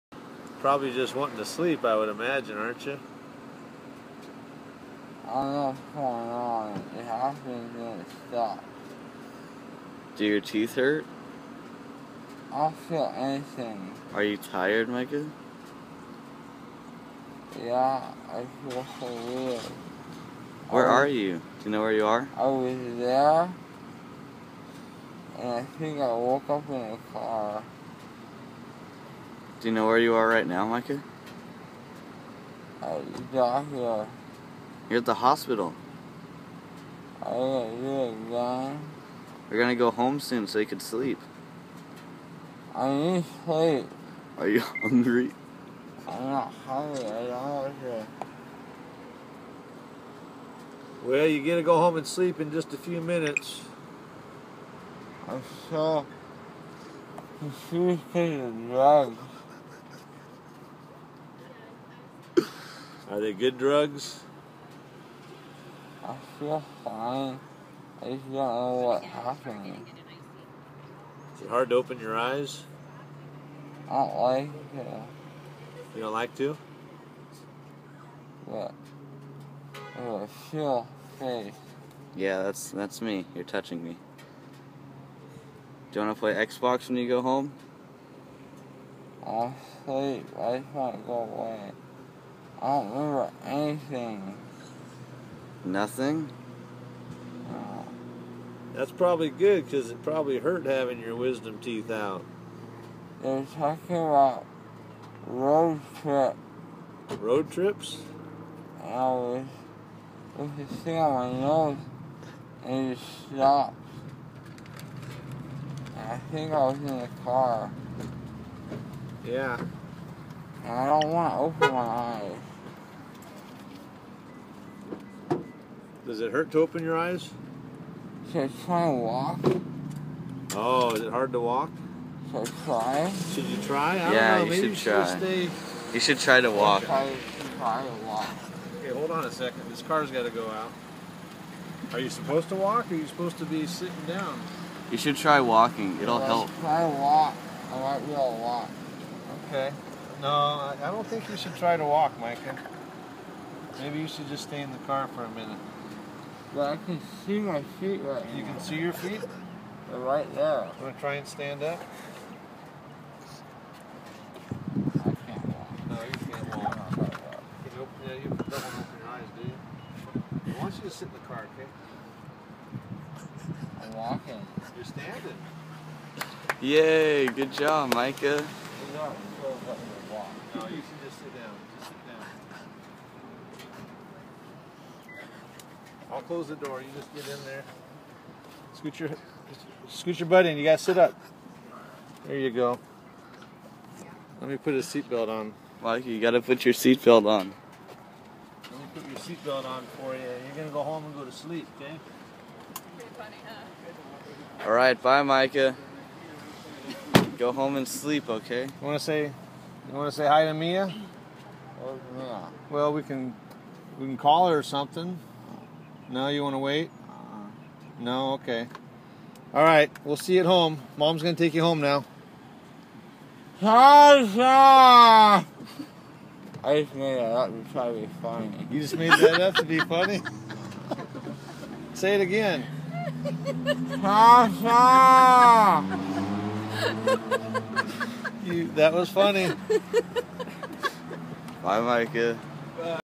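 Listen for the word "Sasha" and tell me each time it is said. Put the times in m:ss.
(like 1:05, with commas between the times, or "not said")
3:43, 3:54.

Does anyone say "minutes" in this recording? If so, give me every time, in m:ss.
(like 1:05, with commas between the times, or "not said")
0:52, 2:35.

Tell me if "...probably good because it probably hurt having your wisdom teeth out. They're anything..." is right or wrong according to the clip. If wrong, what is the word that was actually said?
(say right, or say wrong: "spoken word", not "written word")
wrong: "talking", not "anything".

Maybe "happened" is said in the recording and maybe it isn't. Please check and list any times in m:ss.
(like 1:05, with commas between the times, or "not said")
0:07, 1:09.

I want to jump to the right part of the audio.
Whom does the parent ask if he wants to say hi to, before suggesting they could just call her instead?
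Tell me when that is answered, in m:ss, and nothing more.
3:30.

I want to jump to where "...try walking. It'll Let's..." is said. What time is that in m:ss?
2:25.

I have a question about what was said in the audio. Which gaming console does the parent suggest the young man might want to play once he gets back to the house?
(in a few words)
Xbox.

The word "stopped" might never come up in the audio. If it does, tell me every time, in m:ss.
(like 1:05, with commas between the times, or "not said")
0:08, 1:52.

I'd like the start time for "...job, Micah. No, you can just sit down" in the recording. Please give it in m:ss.
2:57.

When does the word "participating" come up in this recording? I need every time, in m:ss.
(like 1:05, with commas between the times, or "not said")
not said.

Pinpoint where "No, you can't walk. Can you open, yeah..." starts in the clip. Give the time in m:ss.
2:45.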